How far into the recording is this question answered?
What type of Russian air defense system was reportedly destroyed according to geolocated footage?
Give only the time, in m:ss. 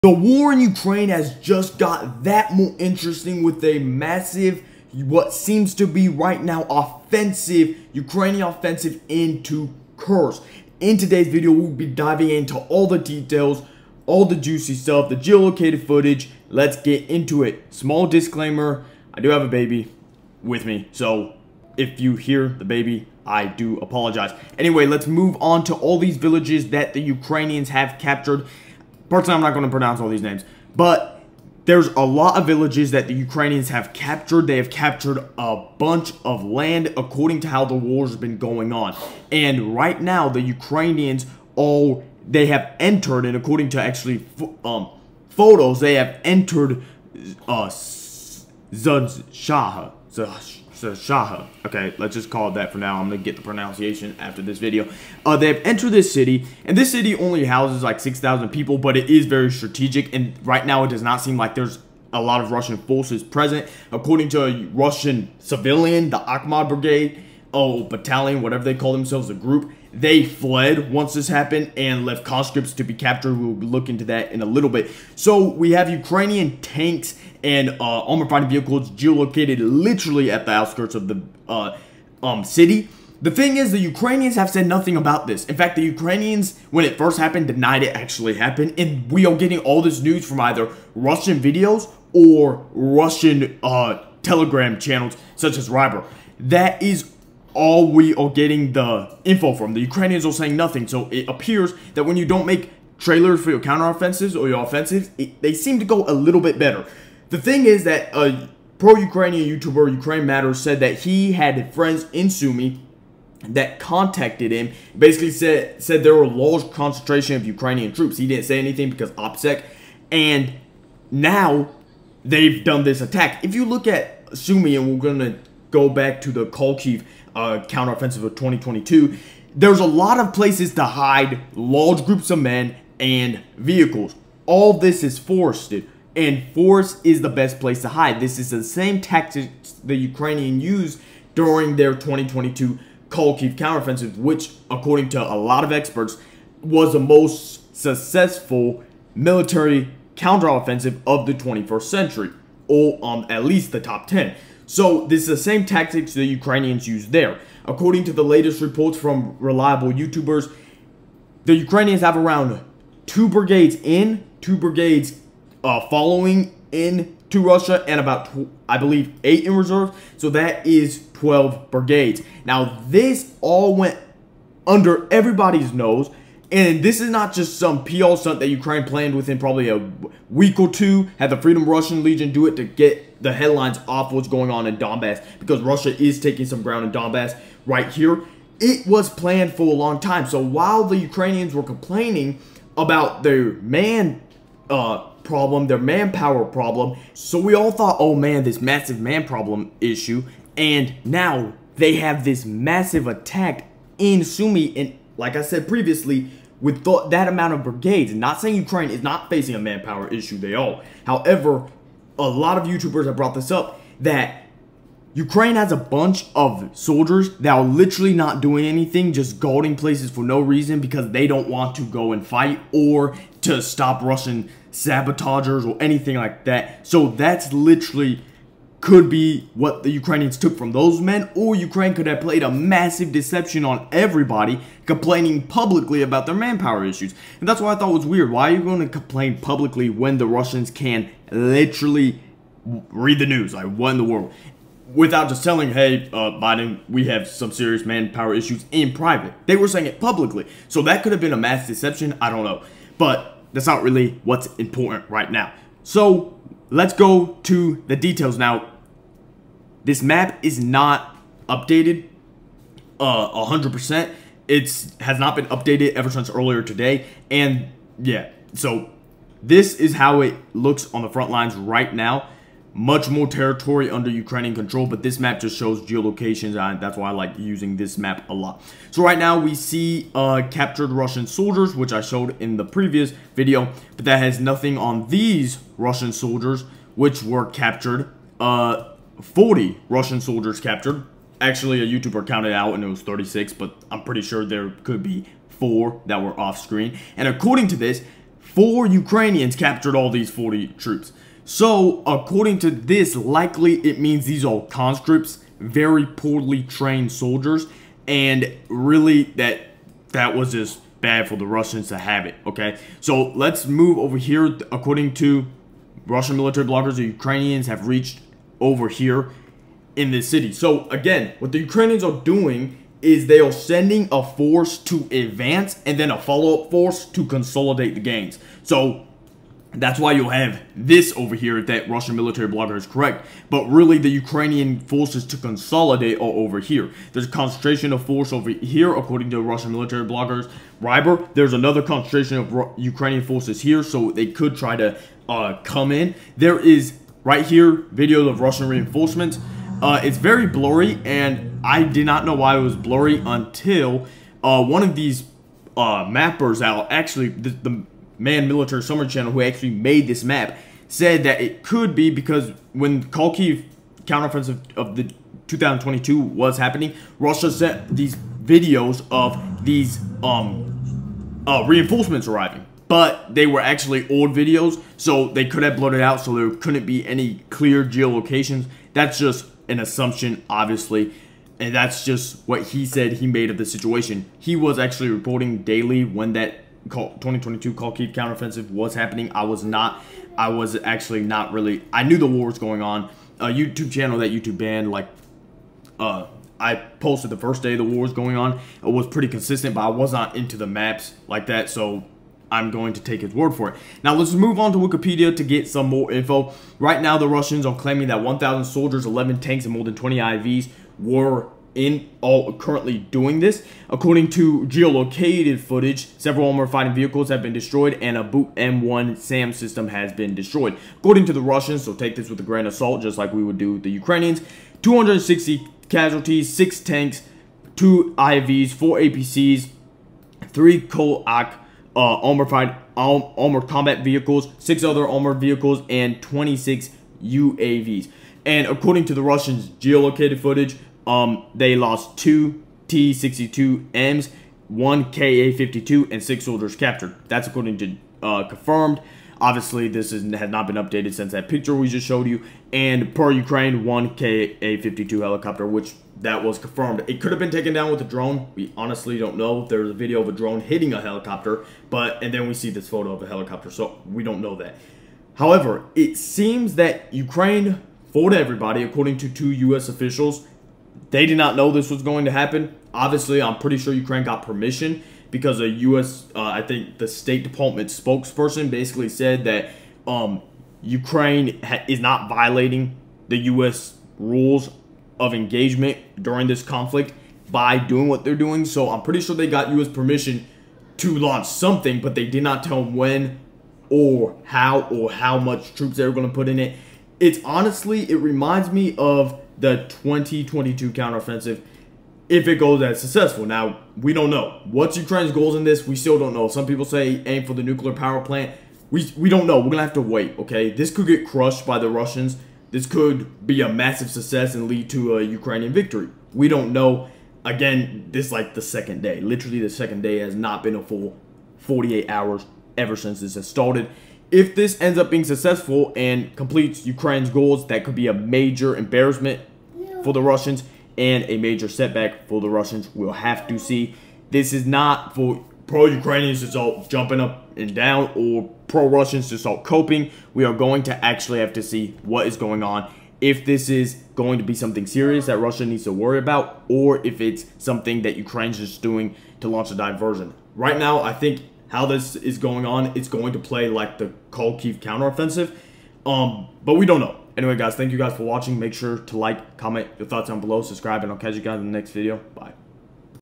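6:58.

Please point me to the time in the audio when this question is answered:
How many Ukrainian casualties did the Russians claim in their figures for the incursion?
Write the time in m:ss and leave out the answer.
7:04.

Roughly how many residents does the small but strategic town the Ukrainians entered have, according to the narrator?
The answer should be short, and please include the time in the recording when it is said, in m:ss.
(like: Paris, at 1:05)
6,000, at 0:57.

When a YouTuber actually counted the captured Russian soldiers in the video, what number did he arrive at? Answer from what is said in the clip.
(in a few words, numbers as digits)
36.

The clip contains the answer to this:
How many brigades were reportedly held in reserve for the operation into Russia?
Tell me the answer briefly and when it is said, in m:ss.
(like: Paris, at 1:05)
8, at 2:49.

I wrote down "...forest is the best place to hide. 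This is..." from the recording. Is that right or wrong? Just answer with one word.
right.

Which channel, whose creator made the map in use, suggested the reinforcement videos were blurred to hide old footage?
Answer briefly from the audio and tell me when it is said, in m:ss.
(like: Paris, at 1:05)
Military Summary Channel, at 5:58.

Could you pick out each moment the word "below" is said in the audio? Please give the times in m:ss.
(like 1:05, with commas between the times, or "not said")
9:20.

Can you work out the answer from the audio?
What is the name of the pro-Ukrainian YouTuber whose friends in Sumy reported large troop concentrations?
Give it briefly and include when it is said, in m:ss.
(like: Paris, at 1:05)
Ukraine Matters, at 1:49.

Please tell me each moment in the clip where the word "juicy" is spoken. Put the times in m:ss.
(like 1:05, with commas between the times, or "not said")
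0:14.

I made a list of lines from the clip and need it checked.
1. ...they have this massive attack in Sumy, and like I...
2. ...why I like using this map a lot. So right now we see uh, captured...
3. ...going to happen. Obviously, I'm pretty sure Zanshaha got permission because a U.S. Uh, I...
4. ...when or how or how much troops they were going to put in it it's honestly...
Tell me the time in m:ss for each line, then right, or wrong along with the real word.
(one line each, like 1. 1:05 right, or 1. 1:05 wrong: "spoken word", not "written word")
1. 3:21 right
2. 4:36 right
3. 7:52 wrong: "Ukraine", not "Zanshaha"
4. 8:12 right.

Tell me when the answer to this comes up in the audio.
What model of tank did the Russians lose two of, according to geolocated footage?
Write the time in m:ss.
7:22.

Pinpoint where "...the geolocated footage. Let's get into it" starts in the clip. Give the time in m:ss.
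0:15.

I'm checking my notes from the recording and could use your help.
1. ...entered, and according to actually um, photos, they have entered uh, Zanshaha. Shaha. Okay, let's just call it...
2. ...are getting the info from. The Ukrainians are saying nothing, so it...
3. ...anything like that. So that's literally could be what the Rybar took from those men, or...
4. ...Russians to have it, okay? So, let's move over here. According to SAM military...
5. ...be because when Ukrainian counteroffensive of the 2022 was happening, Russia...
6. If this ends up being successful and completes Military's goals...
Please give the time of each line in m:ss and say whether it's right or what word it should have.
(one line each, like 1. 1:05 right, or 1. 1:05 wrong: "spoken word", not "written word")
1. 0:42 right
2. 1:38 right
3. 3:45 wrong: "Ukrainians", not "Rybar"
4. 5:11 wrong: "Russian", not "SAM"
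5. 6:01 wrong: "Kharkiv", not "Ukrainian"
6. 8:44 wrong: "Ukraine", not "Military".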